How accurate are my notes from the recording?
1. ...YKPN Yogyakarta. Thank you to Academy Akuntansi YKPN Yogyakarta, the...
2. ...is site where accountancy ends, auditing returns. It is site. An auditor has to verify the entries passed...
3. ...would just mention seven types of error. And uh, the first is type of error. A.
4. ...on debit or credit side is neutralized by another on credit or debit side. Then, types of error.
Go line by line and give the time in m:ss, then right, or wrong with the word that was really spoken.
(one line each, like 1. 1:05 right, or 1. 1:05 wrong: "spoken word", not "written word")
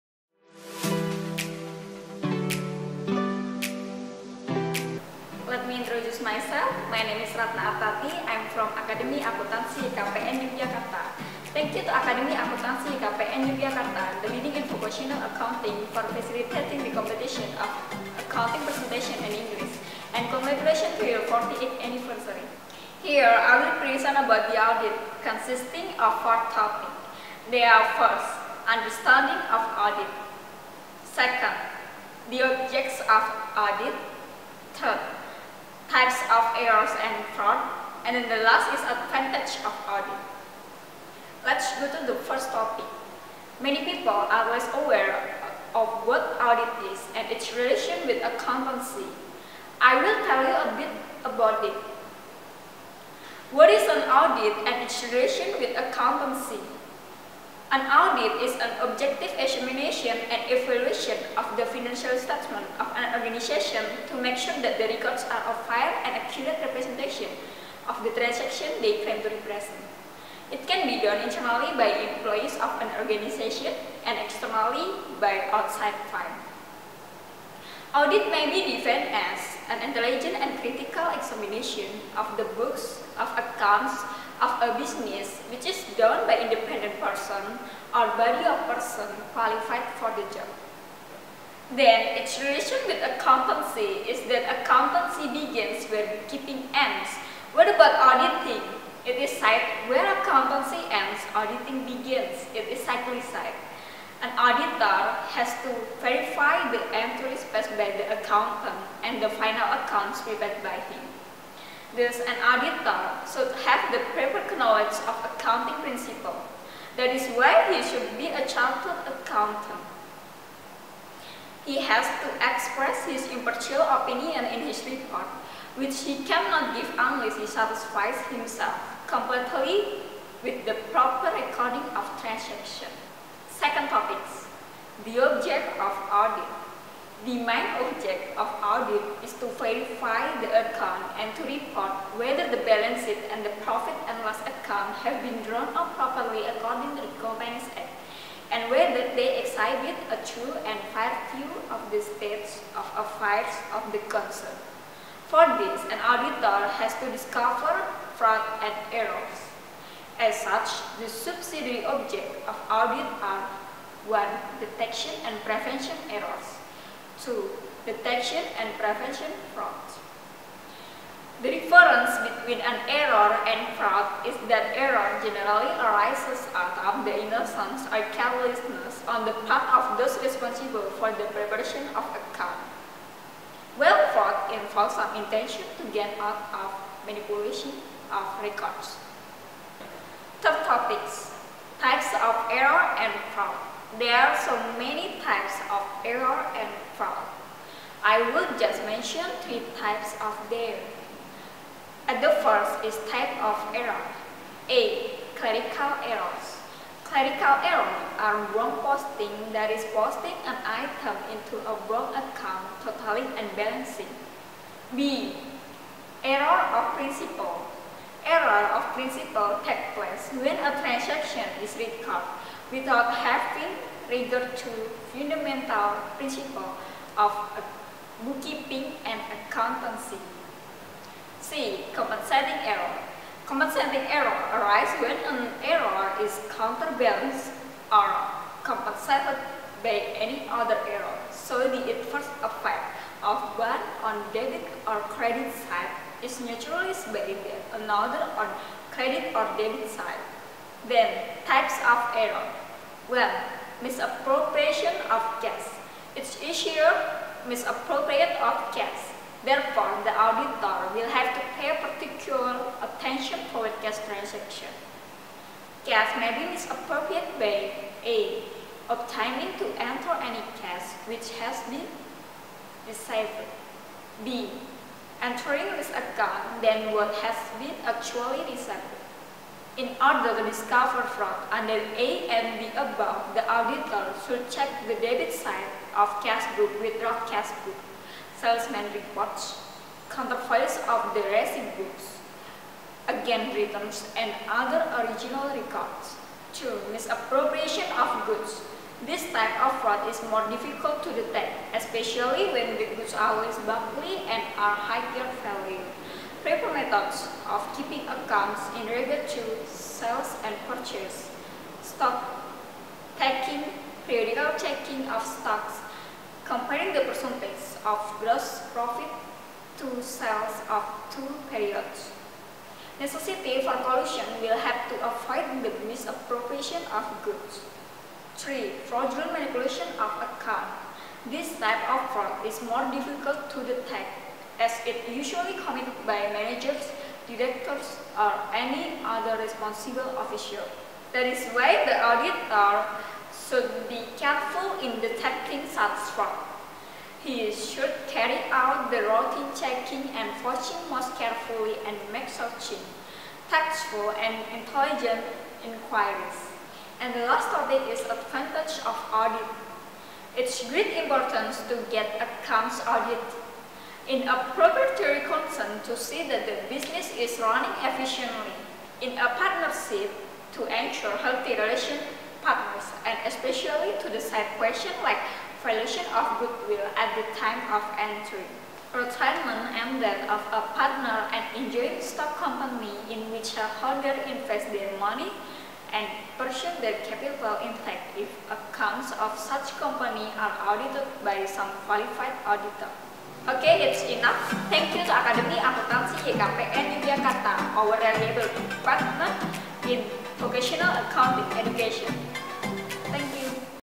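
1. 0:09 right
2. 1:39 wrong: "begins", not "returns"
3. 3:18 wrong: "three", not "seven"
4. 4:04 right.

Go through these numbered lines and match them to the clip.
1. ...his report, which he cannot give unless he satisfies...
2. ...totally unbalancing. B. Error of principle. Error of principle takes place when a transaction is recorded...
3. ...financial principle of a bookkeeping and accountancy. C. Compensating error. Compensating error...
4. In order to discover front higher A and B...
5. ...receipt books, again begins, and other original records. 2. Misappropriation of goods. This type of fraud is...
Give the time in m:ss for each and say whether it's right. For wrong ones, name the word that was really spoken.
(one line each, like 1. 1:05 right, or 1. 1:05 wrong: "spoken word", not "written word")
1. 2:04 right
2. 3:32 right
3. 3:45 wrong: "fundamental", not "financial"
4. 4:39 wrong: "under", not "higher"
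5. 4:51 wrong: "returns", not "begins".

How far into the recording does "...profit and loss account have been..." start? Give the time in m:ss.
2:23.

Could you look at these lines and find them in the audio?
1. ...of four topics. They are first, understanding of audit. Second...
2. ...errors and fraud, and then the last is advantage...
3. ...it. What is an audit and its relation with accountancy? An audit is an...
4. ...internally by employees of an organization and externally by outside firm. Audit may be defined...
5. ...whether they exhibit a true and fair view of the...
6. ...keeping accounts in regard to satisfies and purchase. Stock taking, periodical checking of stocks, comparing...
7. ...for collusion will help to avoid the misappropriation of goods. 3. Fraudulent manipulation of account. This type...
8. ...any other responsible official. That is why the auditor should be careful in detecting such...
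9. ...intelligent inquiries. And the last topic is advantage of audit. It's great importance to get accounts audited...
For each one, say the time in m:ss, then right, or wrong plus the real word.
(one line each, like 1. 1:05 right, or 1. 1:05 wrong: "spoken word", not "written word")
1. 0:25 right
2. 0:36 right
3. 0:51 right
4. 1:11 right
5. 2:28 right
6. 5:07 wrong: "sales", not "satisfies"
7. 5:23 right
8. 5:38 right
9. 5:54 right.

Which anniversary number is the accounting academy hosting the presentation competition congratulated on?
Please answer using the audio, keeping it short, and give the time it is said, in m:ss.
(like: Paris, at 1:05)
48th, at 0:21.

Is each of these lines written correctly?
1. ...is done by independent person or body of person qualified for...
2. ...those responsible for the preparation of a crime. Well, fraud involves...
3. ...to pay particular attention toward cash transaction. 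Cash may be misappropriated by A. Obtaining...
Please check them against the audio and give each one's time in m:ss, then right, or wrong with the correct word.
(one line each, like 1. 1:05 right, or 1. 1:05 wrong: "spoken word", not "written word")
1. 1:25 right
2. 2:59 right
3. 4:21 right.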